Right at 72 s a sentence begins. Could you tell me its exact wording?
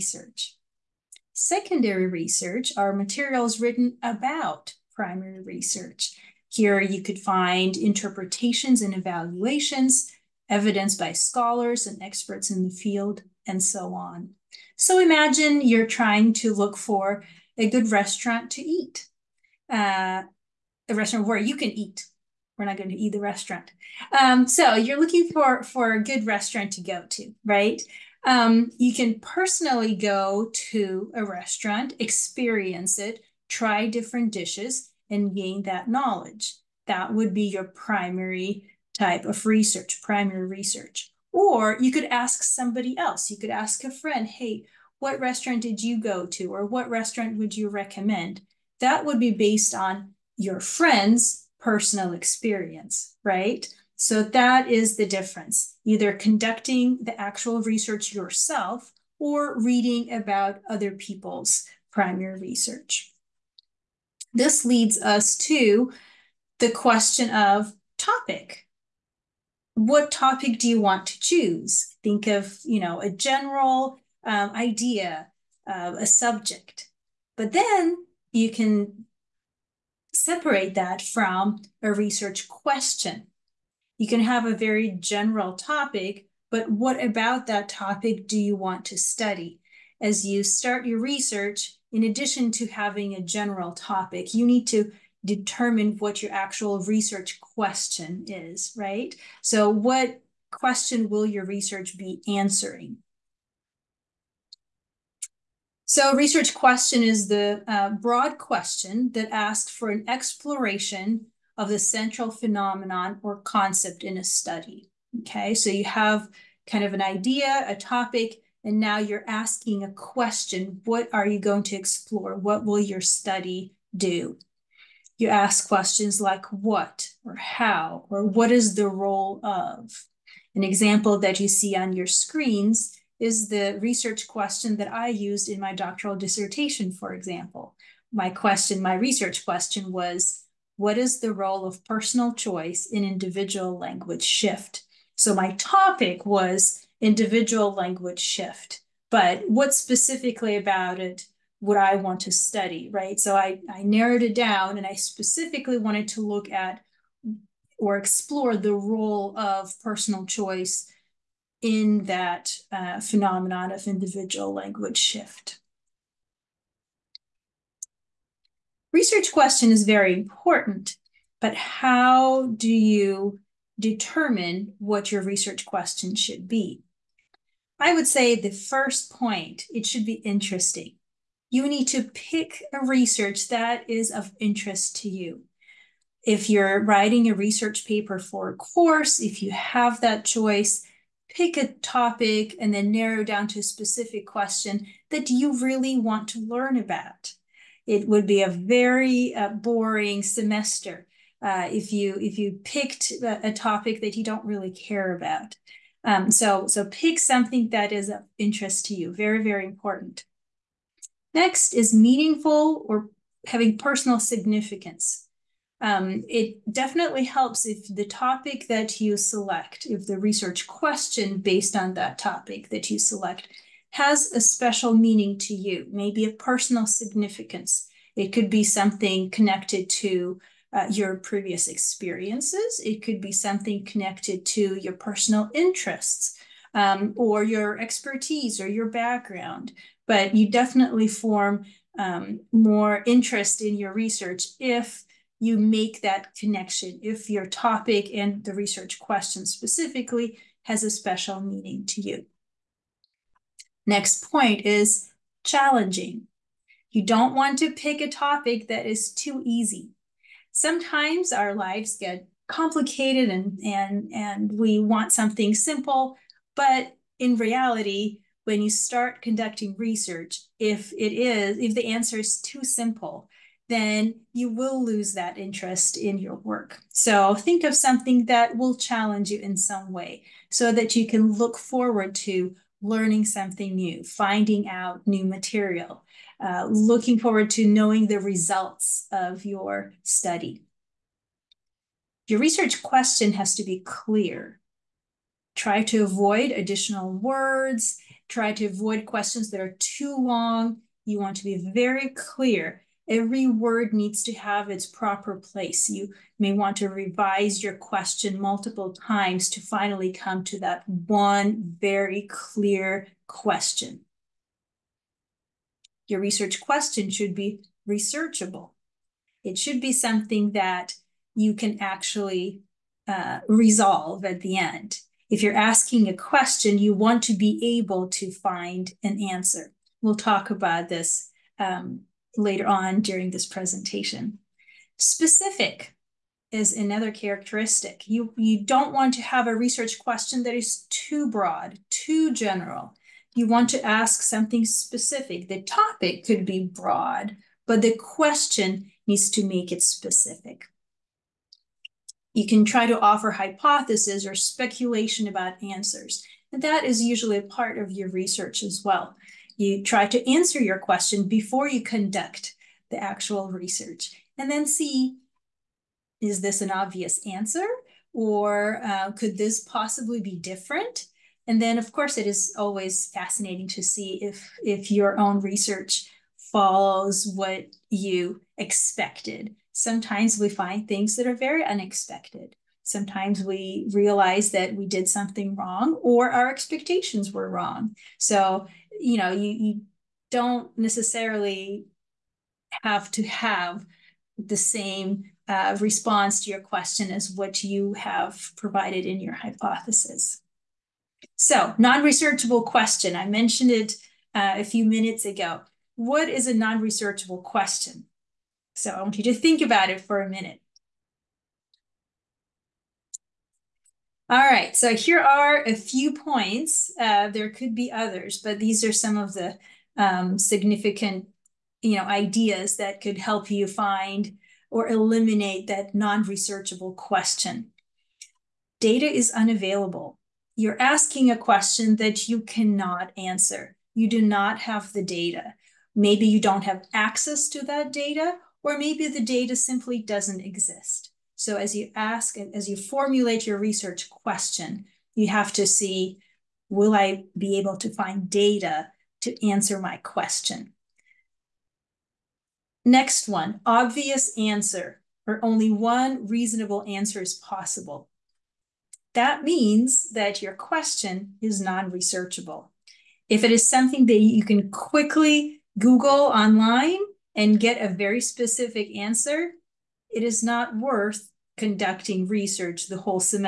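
Think of, you know, a general um, idea, uh, a subject.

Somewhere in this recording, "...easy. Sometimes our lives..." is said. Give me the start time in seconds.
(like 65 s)
259 s.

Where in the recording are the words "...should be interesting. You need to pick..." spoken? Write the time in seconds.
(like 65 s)
179 s.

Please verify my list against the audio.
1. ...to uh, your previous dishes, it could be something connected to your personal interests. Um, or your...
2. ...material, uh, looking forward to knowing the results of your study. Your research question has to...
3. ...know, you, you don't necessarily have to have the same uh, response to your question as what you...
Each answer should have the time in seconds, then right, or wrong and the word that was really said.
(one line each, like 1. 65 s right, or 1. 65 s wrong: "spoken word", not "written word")
1. 230 s wrong: "experiences", not "dishes"
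2. 285 s right
3. 389 s right.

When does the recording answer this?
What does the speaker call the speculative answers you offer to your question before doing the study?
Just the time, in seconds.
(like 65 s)
353 s.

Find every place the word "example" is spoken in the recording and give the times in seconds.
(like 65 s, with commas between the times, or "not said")
130 s, 137 s.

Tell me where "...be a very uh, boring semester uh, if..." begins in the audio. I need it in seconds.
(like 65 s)
198 s.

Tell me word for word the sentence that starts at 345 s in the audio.
The topic could be broad, but the question needs to make it specific.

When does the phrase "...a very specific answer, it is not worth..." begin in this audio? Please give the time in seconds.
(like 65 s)
467 s.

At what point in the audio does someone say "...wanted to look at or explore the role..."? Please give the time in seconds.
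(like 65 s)
155 s.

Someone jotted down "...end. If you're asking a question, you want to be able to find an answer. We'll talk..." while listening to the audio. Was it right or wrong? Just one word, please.
right.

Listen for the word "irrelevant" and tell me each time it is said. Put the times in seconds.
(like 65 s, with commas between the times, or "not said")
not said.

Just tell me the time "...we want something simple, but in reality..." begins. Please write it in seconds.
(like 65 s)
264 s.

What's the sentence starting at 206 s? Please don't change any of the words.
Um, so so pick something that is of interest to you.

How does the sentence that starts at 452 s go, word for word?
Next one, obvious answer, or only one reasonable answer is possible.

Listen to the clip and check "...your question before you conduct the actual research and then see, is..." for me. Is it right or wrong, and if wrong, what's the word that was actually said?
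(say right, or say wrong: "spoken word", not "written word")
right.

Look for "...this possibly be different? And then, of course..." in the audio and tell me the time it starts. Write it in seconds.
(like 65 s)
369 s.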